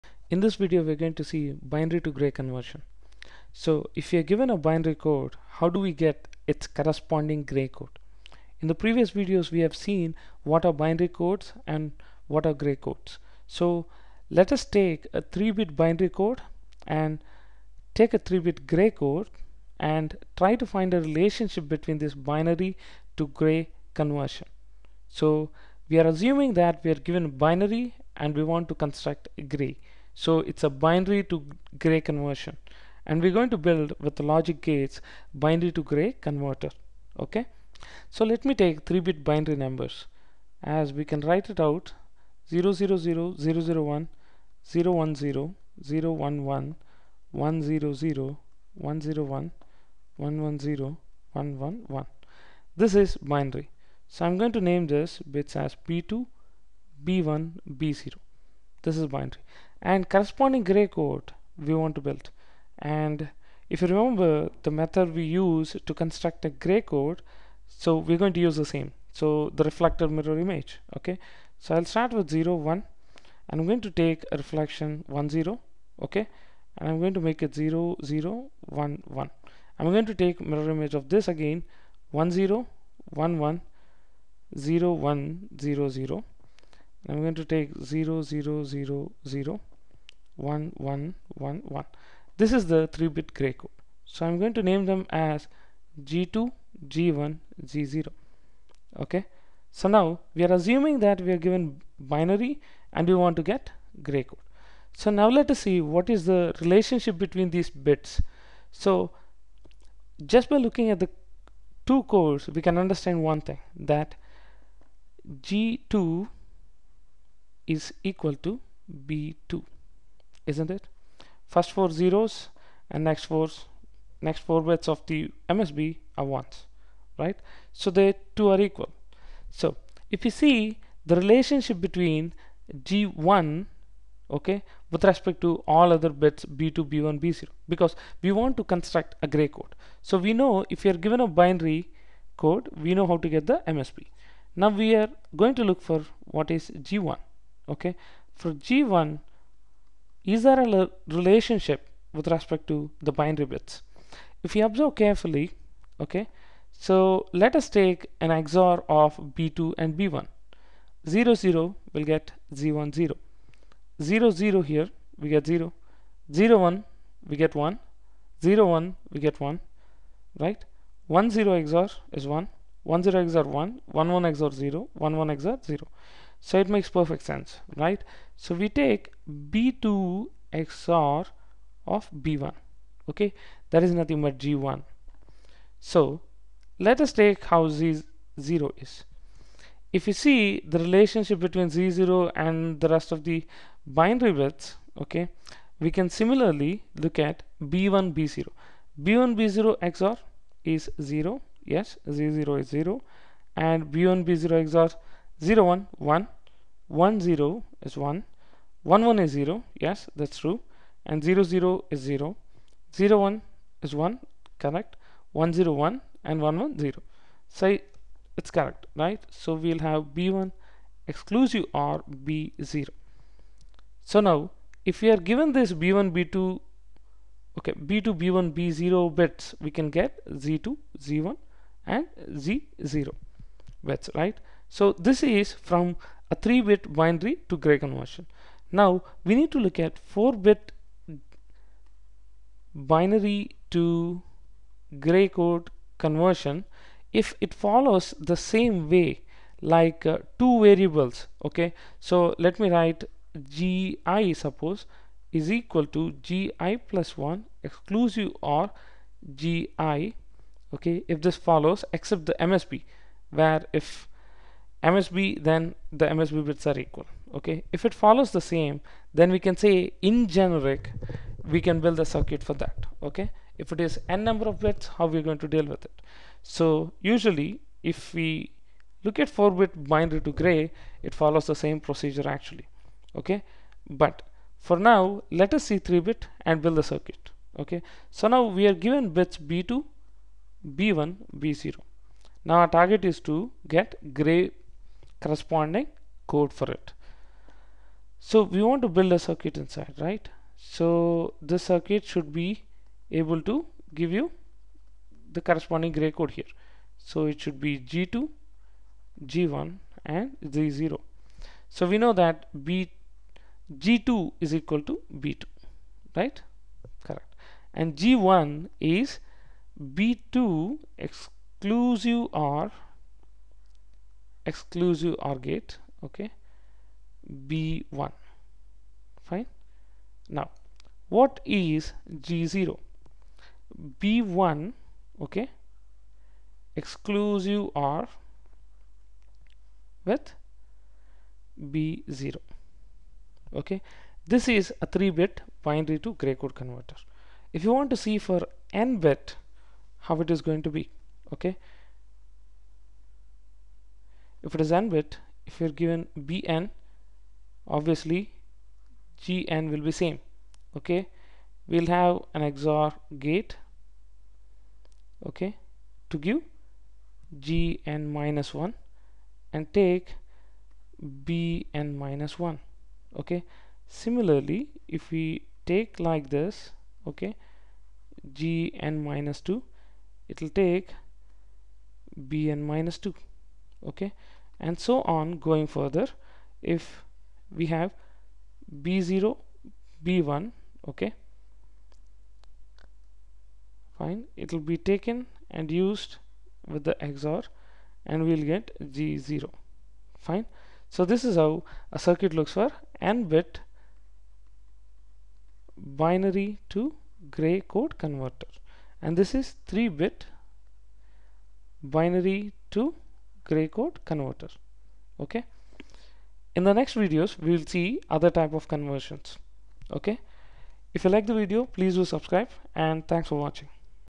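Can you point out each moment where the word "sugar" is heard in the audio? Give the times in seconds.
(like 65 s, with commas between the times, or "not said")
not said.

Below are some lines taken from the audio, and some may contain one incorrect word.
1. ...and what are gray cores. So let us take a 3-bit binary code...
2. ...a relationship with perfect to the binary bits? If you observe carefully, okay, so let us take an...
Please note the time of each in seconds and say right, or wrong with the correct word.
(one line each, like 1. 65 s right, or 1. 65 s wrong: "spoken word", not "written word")
1. 11 s wrong: "codes", not "cores"
2. 150 s wrong: "respect", not "perfect".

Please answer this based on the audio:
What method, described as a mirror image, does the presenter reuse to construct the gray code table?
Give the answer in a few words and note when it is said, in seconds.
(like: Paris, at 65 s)
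reflected mirror image, at 69 s.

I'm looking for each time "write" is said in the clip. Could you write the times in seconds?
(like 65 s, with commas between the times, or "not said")
41 s, 252 s.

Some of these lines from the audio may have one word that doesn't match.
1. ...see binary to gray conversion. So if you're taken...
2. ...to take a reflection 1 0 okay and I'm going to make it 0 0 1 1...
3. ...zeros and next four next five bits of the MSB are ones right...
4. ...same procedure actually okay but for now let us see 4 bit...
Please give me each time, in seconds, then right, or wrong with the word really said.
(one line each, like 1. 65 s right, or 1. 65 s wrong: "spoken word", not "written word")
1. 1 s wrong: "given", not "taken"
2. 73 s right
3. 122 s wrong: "four", not "five"
4. 281 s wrong: "3", not "4".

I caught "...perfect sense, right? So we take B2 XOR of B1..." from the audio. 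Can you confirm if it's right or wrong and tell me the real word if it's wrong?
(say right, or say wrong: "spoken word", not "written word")
right.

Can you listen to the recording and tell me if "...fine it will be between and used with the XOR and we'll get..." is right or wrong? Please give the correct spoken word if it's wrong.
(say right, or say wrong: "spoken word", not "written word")
wrong: "taken", not "between".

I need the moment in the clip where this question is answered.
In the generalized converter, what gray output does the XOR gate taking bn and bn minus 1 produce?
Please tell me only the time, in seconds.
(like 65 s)
367 s.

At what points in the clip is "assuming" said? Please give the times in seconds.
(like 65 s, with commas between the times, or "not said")
26 s, 100 s.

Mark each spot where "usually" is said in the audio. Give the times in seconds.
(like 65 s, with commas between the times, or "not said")
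277 s.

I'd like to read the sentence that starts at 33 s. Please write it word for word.
And we're going to build with the logic gates binary to gray converter.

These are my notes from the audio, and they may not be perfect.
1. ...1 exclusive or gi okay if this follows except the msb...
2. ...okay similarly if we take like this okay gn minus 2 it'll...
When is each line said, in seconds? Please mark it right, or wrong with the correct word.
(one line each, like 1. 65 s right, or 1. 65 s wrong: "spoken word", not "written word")
1. 257 s right
2. 373 s right.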